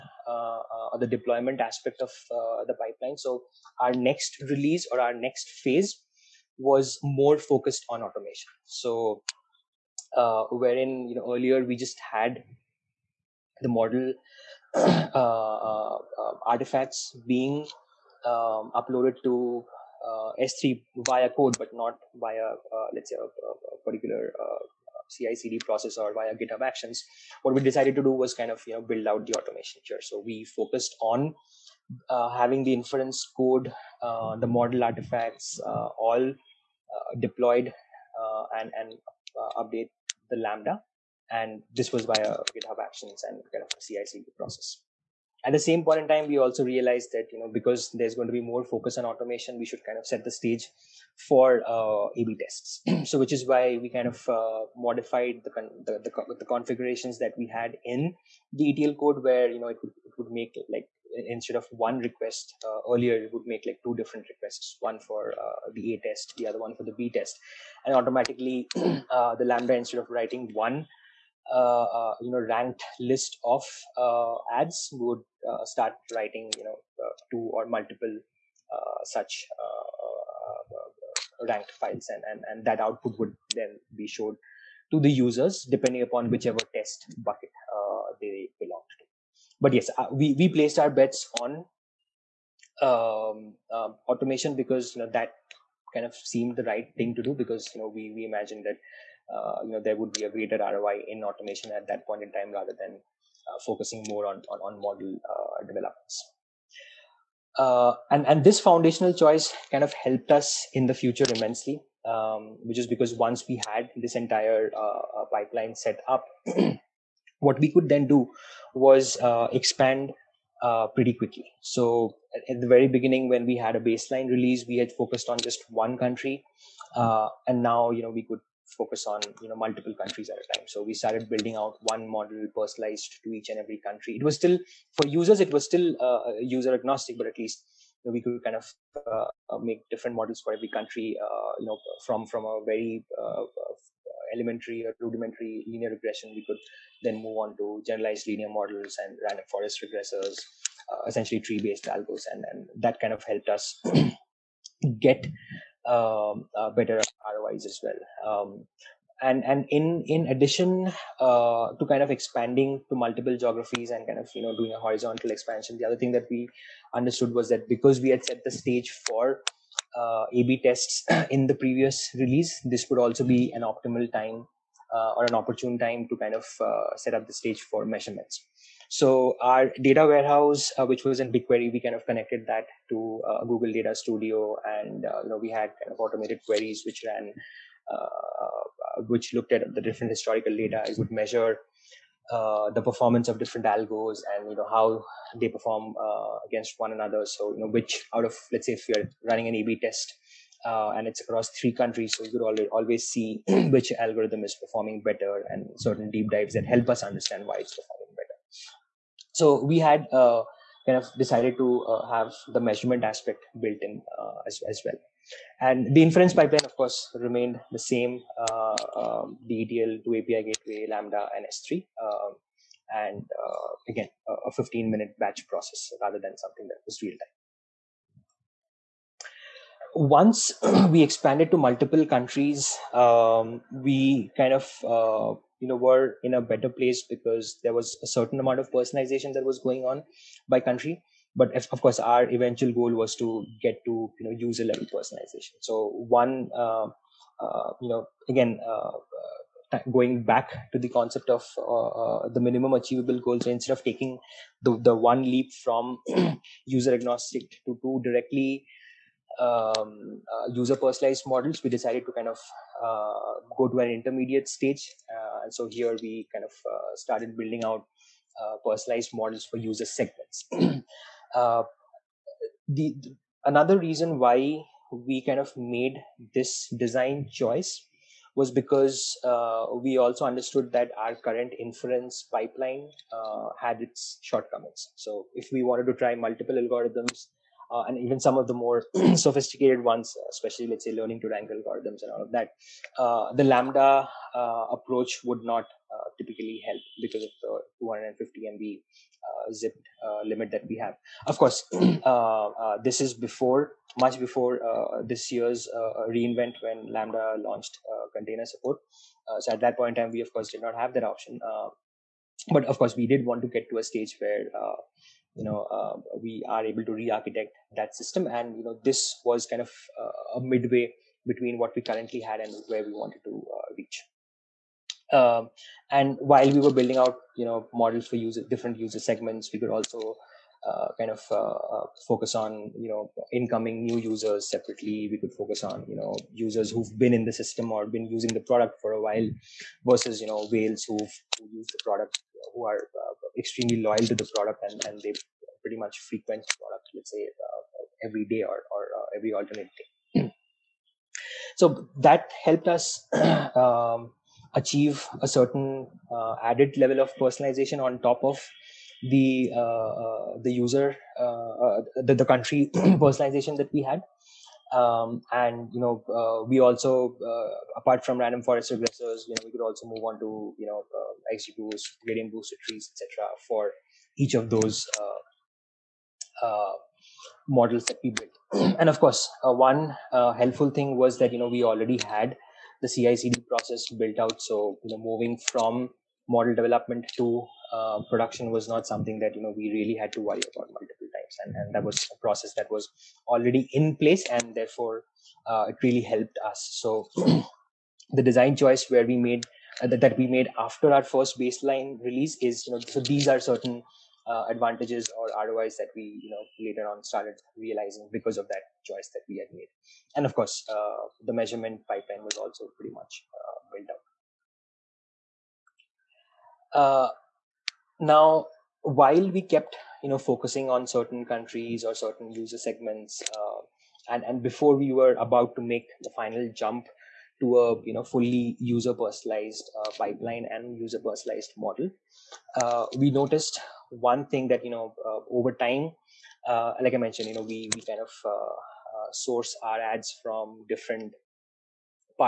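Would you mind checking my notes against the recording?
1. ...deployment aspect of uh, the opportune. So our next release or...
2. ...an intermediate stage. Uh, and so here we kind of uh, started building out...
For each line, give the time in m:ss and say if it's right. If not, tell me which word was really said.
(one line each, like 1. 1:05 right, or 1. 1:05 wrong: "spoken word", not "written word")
1. 0:01 wrong: "pipeline", not "opportune"
2. 4:23 right.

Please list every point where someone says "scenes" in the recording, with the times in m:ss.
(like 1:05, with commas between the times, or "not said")
not said.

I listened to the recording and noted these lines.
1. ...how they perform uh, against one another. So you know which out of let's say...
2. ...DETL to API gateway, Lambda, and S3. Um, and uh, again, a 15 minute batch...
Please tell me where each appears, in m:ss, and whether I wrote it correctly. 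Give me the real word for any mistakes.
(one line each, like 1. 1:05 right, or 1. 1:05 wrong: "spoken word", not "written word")
1. 3:14 right
2. 3:39 right.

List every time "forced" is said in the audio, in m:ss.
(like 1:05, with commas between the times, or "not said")
not said.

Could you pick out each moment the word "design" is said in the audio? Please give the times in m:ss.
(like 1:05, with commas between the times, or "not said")
4:36, 6:38.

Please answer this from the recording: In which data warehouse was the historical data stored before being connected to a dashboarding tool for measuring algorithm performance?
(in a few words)
BigQuery.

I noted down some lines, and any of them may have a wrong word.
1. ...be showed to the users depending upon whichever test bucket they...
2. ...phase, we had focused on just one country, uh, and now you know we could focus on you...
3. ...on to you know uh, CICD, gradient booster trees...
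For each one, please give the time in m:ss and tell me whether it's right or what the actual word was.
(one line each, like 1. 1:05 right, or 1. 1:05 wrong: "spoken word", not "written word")
1. 1:23 right
2. 2:04 wrong: "release", not "phase"
3. 6:10 wrong: "XGBoost", not "CICD".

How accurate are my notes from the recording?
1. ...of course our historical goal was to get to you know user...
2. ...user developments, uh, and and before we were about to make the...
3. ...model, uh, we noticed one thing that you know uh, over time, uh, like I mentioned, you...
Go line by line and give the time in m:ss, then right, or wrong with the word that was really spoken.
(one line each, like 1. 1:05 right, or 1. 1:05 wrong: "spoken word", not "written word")
1. 4:01 wrong: "eventual", not "historical"
2. 7:02 wrong: "segments", not "developments"
3. 7:11 right.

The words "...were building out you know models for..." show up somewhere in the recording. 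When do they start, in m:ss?
5:26.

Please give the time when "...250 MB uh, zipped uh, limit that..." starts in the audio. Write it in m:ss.
4:57.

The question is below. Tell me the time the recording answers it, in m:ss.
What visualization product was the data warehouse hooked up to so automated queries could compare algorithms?
3:03.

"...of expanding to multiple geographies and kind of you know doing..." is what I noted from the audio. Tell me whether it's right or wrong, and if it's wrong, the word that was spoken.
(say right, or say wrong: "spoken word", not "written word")
right.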